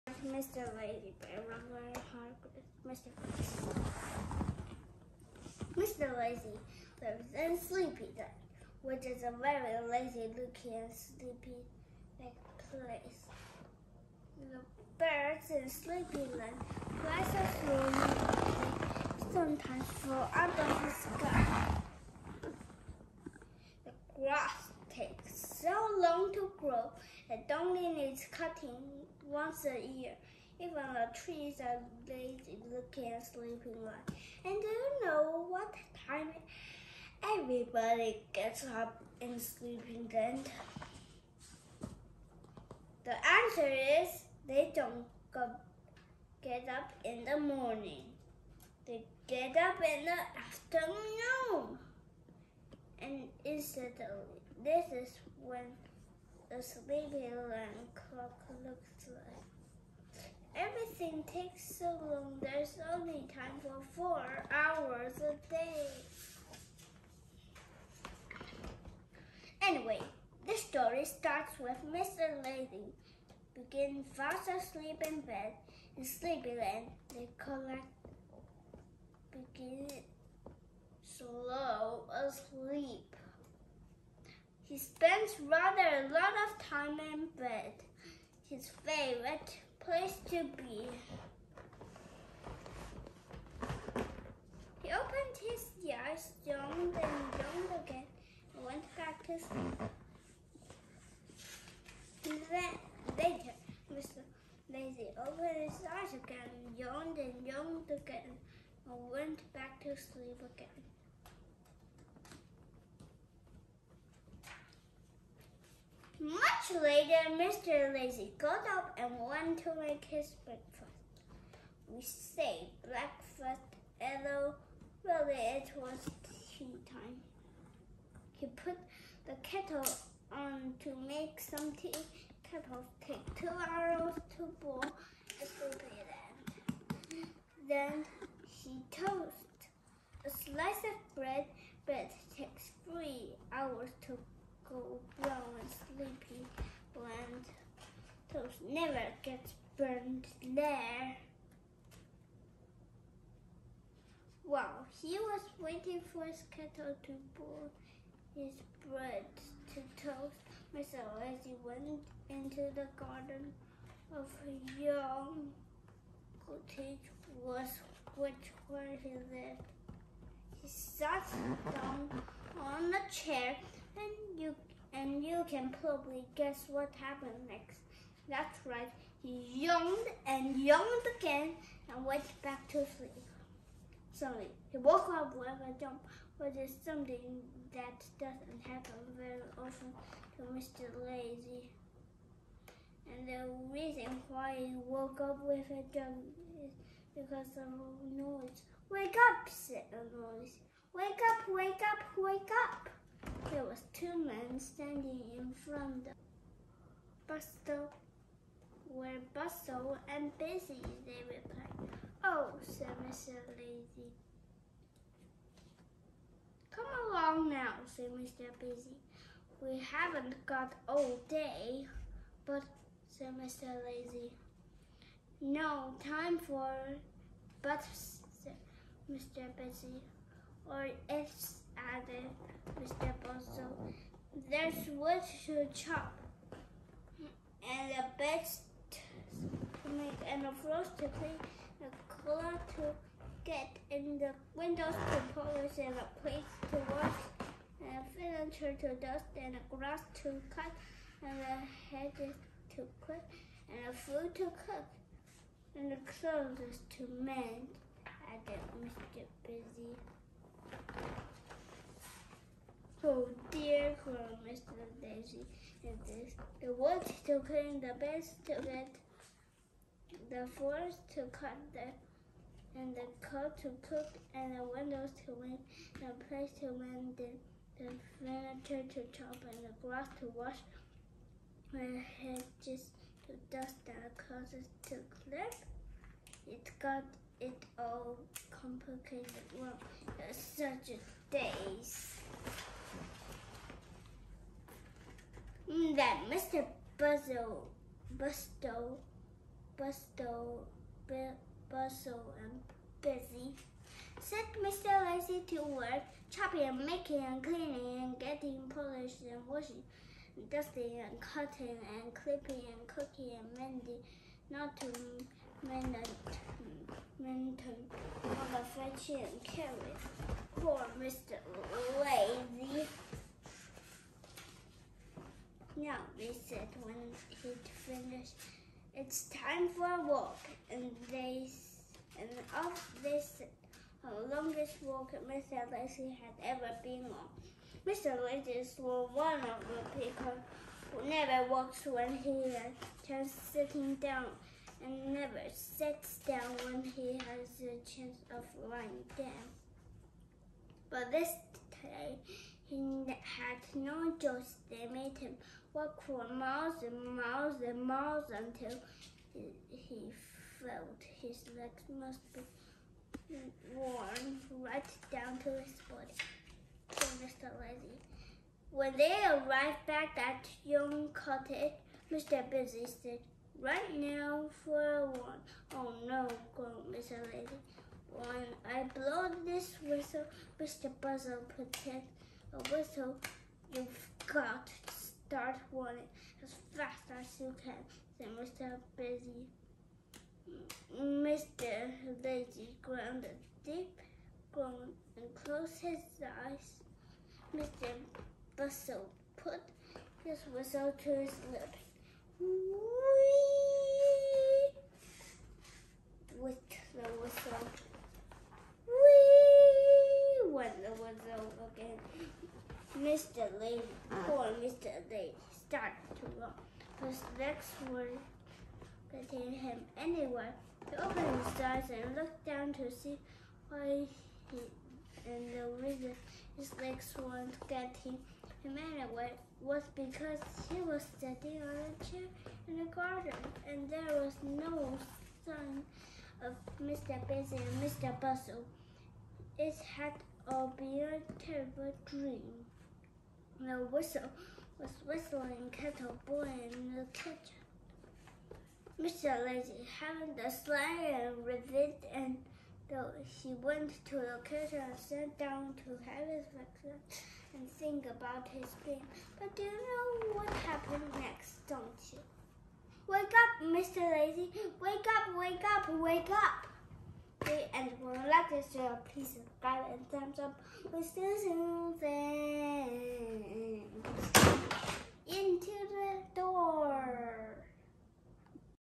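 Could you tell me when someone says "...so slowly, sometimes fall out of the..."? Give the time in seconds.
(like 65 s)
17 s.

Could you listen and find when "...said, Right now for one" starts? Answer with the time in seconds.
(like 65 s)
372 s.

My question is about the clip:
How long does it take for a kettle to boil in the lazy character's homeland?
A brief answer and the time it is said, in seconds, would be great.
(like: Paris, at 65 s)
2 hours, at 133 s.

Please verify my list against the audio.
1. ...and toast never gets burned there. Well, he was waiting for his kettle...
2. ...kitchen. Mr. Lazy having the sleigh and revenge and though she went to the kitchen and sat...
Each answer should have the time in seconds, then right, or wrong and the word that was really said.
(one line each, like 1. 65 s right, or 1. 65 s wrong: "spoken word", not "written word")
1. 146 s right
2. 447 s right.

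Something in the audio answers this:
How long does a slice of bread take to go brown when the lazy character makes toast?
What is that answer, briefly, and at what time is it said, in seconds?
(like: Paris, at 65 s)
3 hours, at 142 s.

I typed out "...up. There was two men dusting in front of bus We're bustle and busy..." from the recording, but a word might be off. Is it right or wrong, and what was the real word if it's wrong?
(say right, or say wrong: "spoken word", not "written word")
wrong: "standing", not "dusting".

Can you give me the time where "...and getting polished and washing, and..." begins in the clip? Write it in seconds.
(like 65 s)
308 s.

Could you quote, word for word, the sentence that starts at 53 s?
And instead, this is when the sleepy alarm clock looks like.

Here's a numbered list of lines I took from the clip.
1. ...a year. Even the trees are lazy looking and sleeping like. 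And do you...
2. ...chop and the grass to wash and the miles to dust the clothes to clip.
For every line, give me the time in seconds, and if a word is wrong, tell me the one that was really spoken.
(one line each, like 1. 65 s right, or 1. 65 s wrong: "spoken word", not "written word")
1. 29 s right
2. 279 s wrong: "hedges", not "miles".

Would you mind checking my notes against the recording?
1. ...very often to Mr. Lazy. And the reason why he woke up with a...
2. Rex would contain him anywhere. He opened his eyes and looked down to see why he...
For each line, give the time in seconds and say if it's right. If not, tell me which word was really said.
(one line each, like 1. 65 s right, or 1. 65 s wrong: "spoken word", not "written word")
1. 189 s right
2. 417 s right.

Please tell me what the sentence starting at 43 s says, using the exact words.
The answer is they don't go, get up in the morning.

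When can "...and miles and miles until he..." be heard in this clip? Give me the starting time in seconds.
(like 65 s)
356 s.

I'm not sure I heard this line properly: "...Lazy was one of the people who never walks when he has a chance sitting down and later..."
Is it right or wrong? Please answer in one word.
wrong.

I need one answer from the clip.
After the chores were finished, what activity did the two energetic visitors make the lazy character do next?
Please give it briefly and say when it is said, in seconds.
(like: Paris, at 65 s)
a walk, at 329 s.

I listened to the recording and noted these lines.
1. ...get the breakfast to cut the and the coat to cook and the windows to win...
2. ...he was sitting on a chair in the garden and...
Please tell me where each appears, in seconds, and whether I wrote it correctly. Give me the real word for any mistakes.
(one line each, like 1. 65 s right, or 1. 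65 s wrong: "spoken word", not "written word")
1. 268 s wrong: "forest", not "breakfast"
2. 430 s right.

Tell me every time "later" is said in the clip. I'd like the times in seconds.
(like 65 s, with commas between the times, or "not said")
103 s, 116 s.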